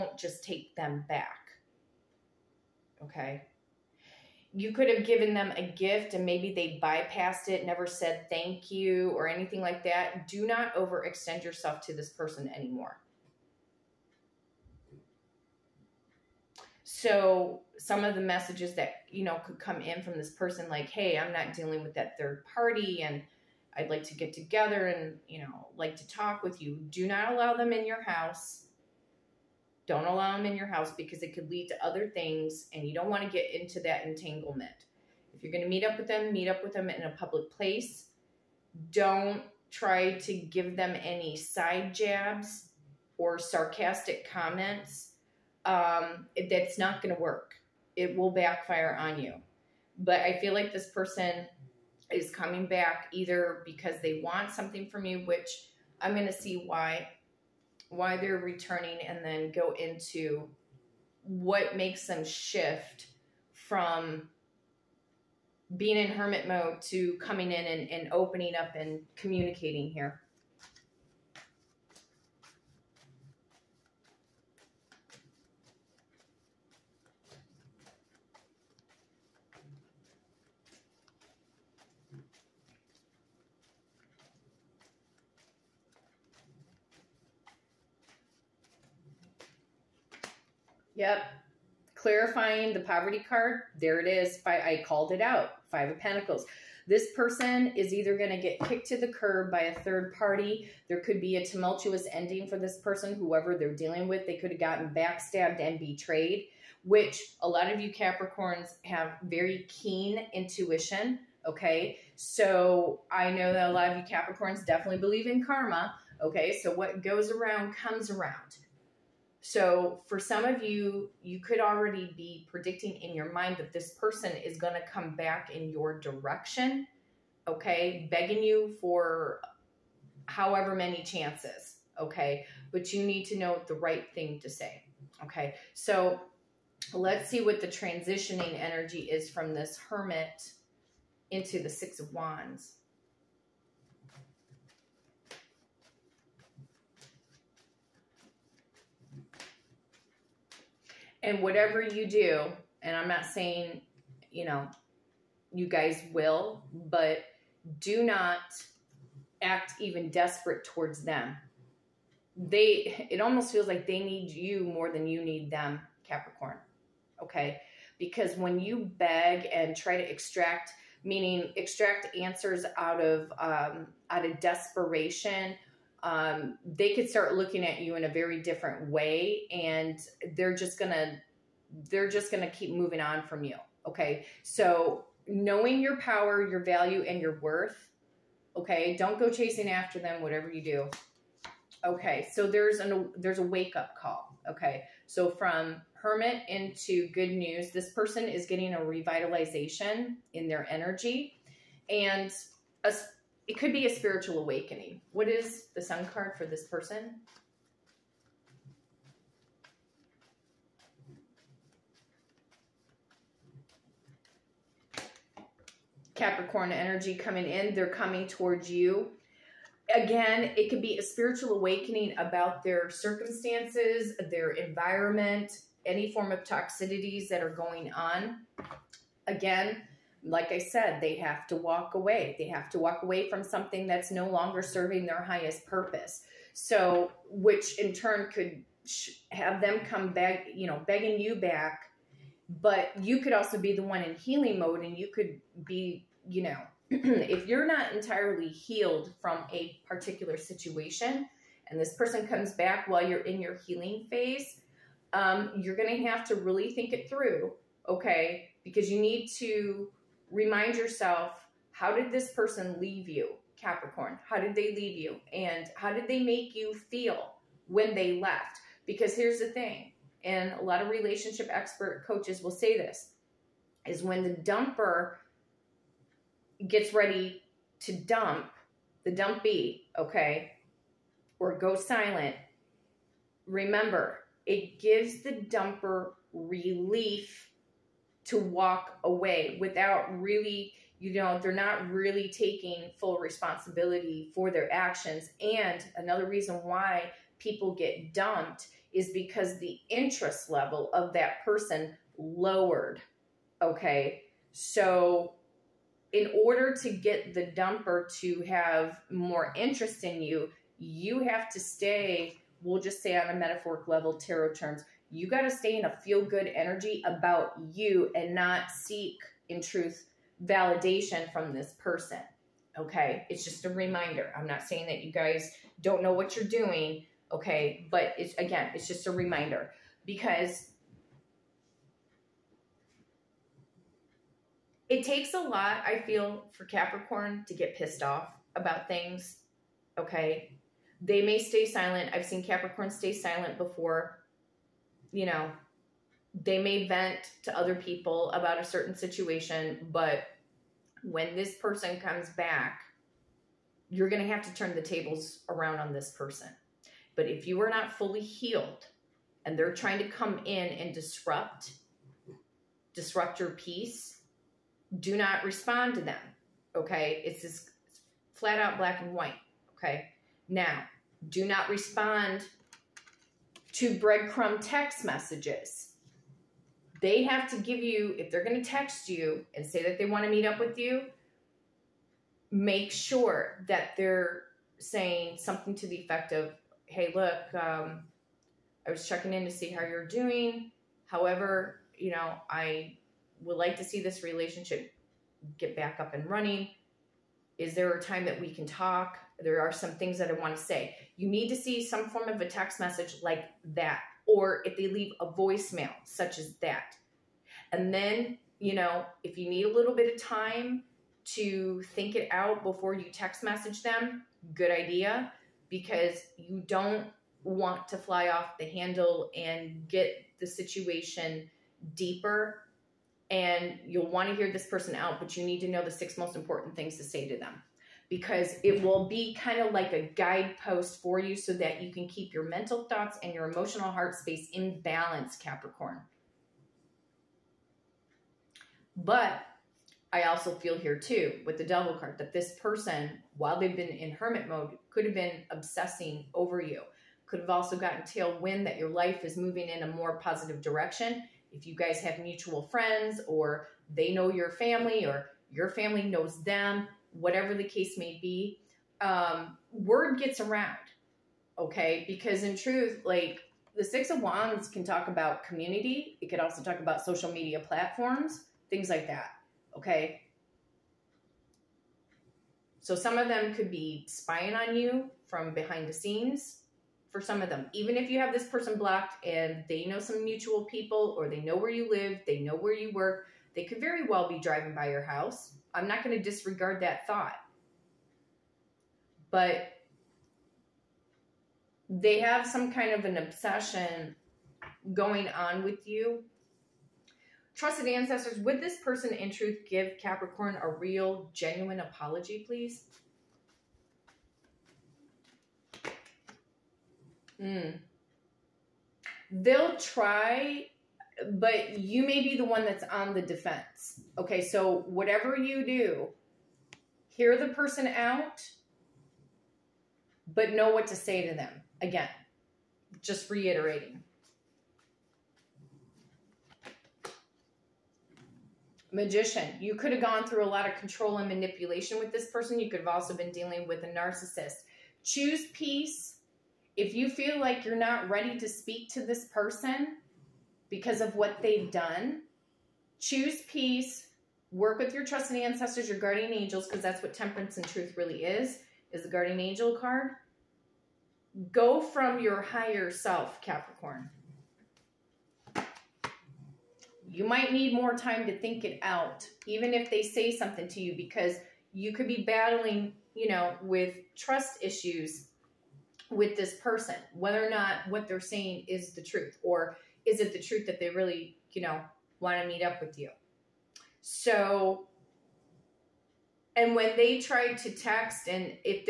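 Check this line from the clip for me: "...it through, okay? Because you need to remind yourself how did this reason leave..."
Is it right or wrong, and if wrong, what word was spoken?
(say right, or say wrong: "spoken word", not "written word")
wrong: "person", not "reason".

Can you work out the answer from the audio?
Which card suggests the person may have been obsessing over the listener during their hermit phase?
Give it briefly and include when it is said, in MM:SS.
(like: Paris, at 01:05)
The Devil, at 07:21.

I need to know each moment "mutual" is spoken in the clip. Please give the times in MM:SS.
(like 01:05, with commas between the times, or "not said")
07:32, 08:00.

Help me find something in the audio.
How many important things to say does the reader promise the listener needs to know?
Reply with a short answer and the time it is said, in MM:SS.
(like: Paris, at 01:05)
6, at 07:05.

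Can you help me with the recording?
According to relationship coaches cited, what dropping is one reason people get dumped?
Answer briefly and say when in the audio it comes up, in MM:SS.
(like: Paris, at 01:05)
Interest level, at 04:59.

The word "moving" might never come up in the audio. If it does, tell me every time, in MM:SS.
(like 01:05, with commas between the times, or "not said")
03:02, 07:29.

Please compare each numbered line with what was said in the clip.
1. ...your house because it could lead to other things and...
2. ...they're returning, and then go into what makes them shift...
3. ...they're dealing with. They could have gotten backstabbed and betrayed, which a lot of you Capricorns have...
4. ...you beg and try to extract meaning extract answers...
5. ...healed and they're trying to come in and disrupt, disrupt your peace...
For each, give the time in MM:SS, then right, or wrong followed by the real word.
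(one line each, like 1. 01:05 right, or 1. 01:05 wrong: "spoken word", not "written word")
1. 00:30 right
2. 00:58 right
3. 01:43 right
4. 02:48 right
5. 05:58 right.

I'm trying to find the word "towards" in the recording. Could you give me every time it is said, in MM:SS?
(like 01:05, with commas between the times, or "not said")
02:40, 03:38.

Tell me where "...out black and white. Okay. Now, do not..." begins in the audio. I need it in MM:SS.
06:08.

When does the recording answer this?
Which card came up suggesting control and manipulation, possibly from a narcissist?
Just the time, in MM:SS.
08:48.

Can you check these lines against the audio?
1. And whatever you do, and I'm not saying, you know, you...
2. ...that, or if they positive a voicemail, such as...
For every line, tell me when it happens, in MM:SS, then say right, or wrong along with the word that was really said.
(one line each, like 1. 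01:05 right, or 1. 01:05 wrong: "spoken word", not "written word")
1. 02:31 right
2. 06:43 wrong: "leave", not "positive".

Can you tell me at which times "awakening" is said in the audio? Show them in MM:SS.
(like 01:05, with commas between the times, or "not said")
03:24, 03:41.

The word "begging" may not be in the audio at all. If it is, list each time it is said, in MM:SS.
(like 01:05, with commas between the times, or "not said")
02:08, 04:00.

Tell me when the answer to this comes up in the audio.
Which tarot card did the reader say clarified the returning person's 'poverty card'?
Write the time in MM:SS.
01:35.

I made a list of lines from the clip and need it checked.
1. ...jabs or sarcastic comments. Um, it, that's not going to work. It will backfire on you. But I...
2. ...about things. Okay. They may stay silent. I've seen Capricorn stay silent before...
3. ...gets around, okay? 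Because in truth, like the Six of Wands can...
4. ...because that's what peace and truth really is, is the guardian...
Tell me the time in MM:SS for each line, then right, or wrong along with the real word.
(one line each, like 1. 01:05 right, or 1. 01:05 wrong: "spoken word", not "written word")
1. 00:41 right
2. 05:38 right
3. 07:40 right
4. 09:06 wrong: "temperance", not "peace".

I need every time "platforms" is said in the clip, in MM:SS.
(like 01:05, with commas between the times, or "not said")
07:47.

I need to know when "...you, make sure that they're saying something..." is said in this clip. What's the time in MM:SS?
06:20.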